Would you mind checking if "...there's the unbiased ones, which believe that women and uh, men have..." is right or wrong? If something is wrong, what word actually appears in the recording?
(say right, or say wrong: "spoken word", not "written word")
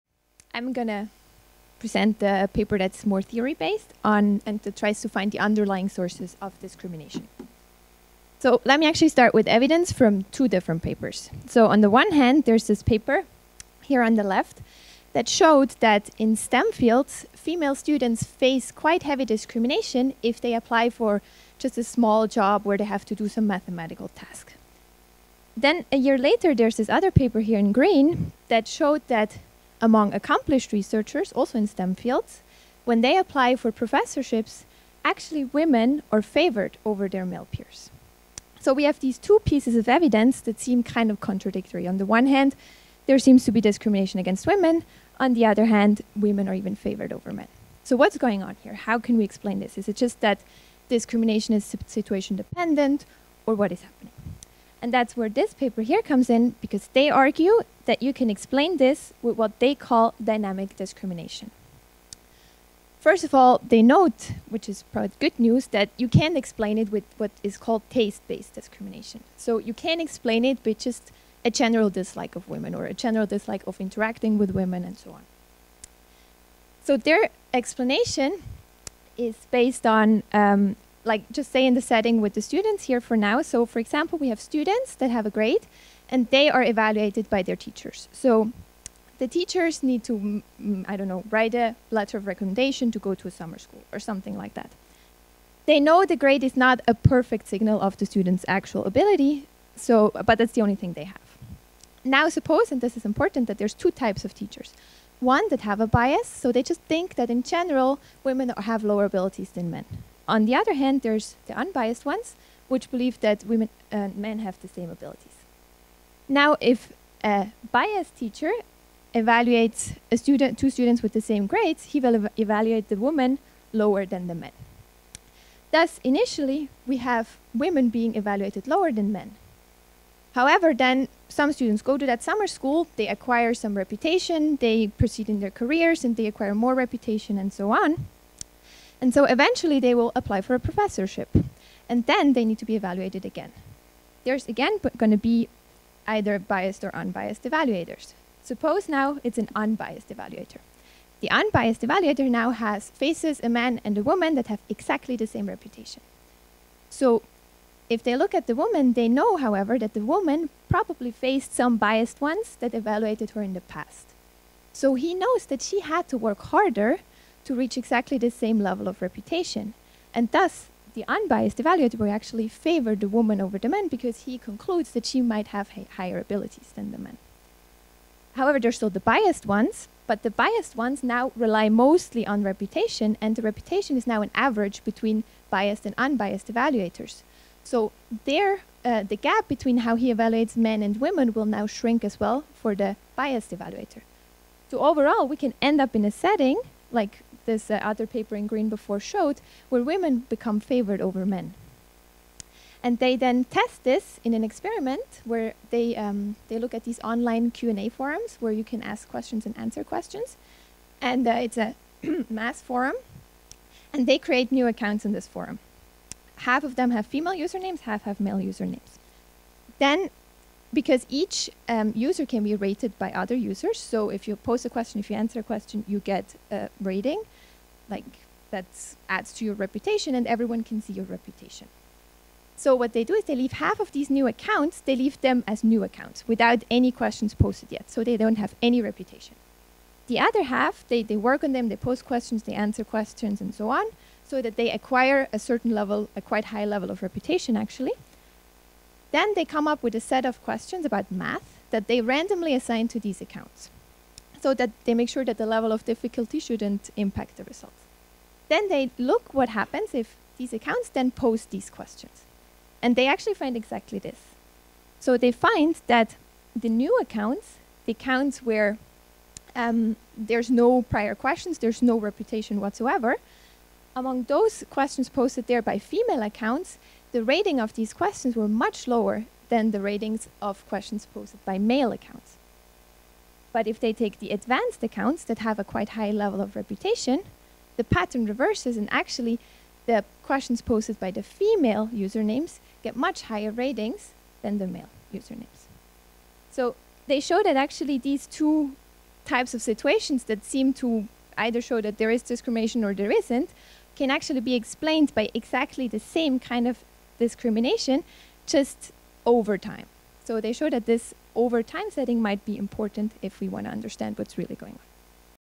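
right.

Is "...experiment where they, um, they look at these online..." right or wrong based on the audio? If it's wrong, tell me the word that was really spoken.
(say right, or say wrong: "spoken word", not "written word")
right.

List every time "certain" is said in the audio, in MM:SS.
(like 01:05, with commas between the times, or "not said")
04:05.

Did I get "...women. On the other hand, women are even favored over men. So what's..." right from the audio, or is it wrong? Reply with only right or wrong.
right.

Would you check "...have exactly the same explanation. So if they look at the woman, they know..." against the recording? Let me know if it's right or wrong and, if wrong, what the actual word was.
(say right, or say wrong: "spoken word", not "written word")
wrong: "reputation", not "explanation".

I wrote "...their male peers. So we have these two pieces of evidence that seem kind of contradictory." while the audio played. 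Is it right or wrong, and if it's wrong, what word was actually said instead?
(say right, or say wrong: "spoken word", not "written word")
right.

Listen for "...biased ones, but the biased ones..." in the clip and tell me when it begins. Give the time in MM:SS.
02:59.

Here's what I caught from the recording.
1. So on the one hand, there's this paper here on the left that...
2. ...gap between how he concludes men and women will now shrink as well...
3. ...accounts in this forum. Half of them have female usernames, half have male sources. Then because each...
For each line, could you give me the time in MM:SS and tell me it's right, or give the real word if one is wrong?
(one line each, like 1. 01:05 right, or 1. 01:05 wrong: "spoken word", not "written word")
1. 00:11 right
2. 03:09 wrong: "evaluates", not "concludes"
3. 03:34 wrong: "usernames", not "sources".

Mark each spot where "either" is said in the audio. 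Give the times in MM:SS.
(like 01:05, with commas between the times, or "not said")
02:26, 05:01.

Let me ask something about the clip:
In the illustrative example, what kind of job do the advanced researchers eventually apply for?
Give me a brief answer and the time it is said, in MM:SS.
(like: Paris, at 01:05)
Professorship, at 02:20.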